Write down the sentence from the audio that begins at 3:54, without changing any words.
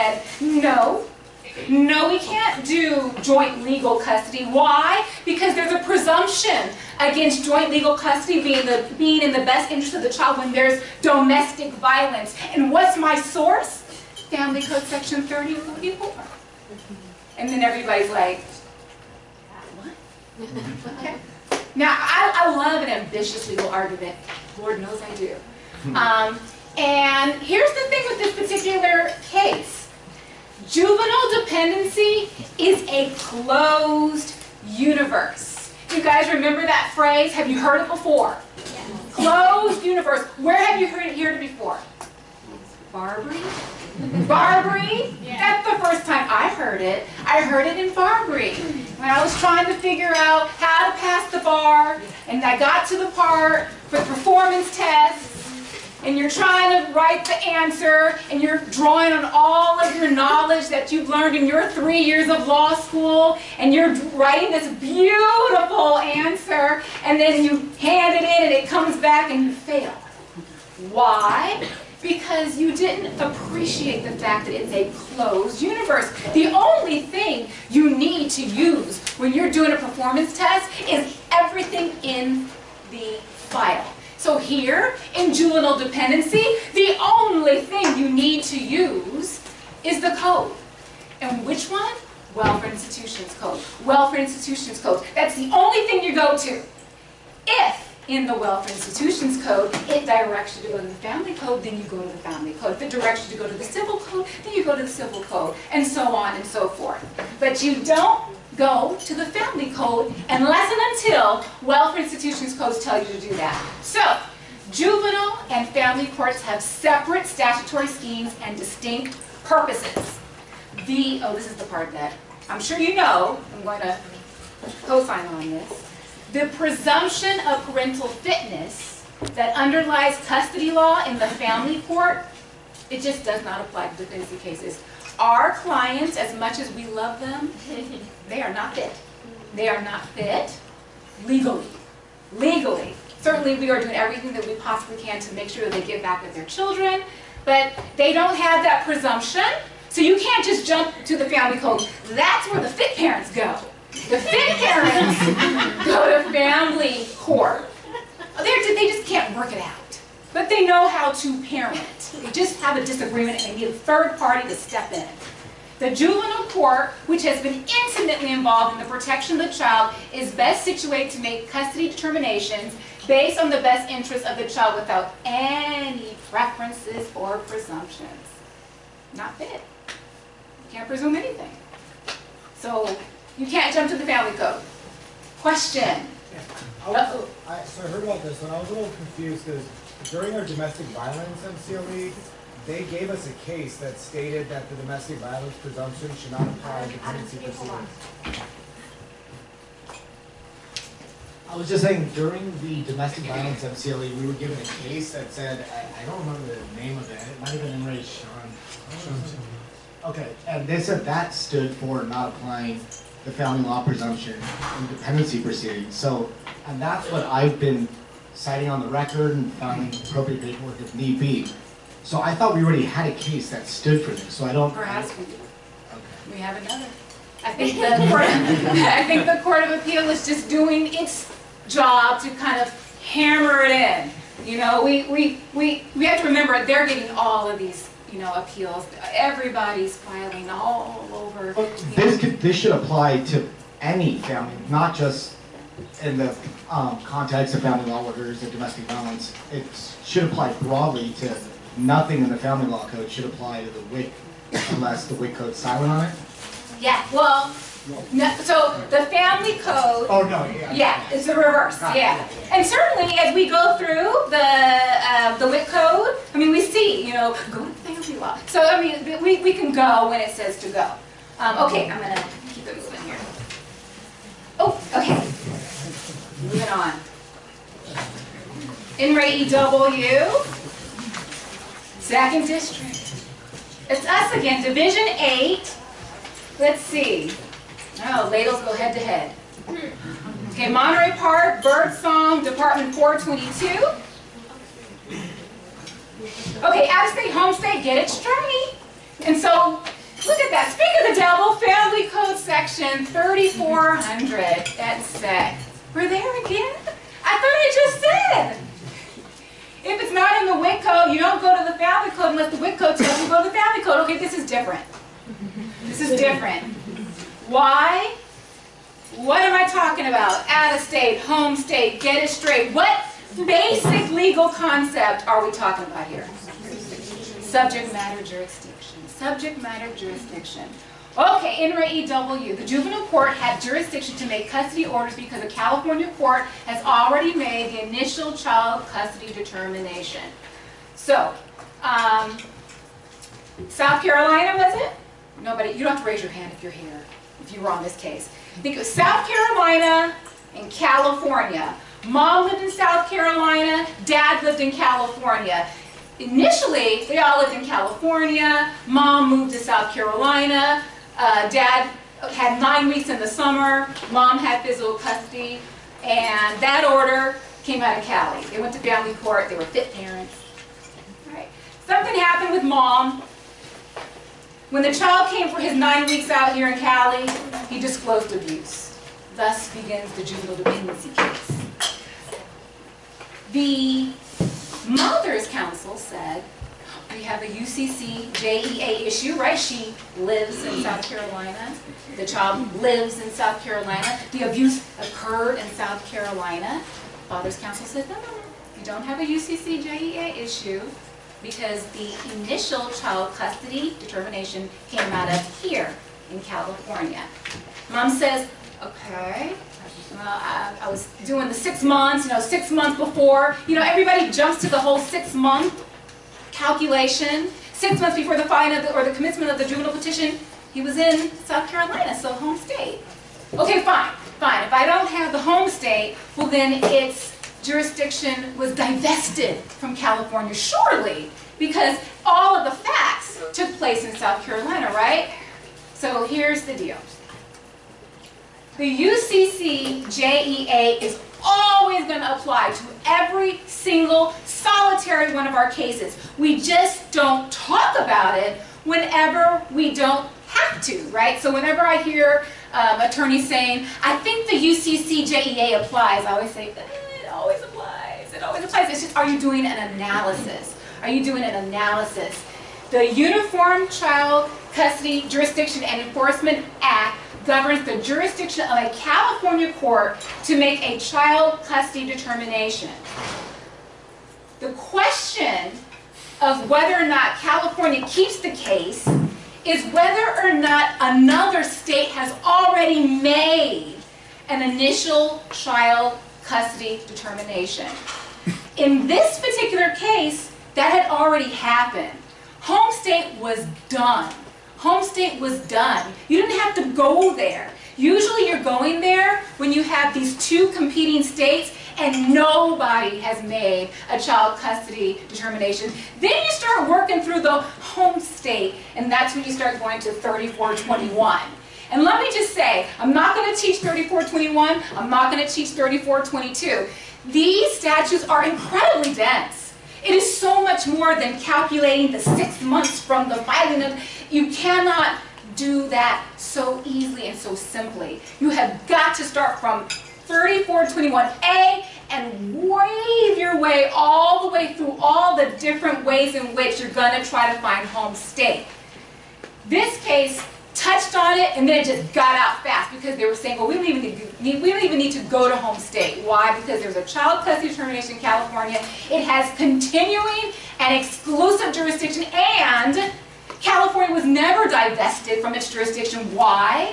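You know, we, we, we, we have to remember they're getting all of these, you know, appeals.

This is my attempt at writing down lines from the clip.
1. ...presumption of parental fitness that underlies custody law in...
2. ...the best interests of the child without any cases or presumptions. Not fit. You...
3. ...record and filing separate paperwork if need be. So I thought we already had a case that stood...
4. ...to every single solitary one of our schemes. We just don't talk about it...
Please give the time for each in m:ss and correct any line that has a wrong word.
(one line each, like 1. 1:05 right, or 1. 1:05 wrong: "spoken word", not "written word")
1. 2:06 right
2. 2:53 wrong: "preferences", not "cases"
3. 3:38 wrong: "appropriate", not "separate"
4. 7:22 wrong: "cases", not "schemes".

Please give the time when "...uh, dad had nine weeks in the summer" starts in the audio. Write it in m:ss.
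6:01.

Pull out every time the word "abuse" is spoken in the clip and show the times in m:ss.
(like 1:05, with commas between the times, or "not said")
6:18, 6:34.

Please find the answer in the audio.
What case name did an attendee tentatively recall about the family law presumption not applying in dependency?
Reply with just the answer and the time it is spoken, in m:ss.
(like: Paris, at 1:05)
In re Sean, at 3:27.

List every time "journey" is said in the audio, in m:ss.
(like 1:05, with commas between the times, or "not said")
4:58.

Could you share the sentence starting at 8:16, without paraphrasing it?
You didn't have to go there.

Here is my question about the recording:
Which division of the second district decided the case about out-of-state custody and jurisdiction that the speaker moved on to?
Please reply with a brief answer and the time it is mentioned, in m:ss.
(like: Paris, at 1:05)
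Division 8, at 4:44.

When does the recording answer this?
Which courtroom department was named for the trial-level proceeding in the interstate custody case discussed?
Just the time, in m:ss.
4:52.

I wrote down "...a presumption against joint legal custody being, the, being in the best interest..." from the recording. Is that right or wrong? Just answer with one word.
right.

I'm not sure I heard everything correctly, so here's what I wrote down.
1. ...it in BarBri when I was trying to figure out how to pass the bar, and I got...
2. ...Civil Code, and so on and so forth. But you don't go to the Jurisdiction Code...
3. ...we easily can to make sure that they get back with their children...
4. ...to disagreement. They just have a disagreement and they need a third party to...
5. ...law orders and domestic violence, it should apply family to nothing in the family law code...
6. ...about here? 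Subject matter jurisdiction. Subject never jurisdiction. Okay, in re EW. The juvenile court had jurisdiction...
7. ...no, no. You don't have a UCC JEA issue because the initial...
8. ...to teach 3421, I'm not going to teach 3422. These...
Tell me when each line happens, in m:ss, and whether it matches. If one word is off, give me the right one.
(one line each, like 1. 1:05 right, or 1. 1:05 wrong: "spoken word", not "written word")
1. 0:47 right
2. 1:44 wrong: "Family", not "Jurisdiction"
3. 2:24 wrong: "possibly", not "easily"
4. 2:41 wrong: "parent", not "disagreement"
5. 4:07 wrong: "broadly", not "family"
6. 5:25 wrong: "matter", not "never"
7. 6:38 right
8. 8:33 right.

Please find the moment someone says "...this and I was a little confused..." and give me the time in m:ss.
3:08.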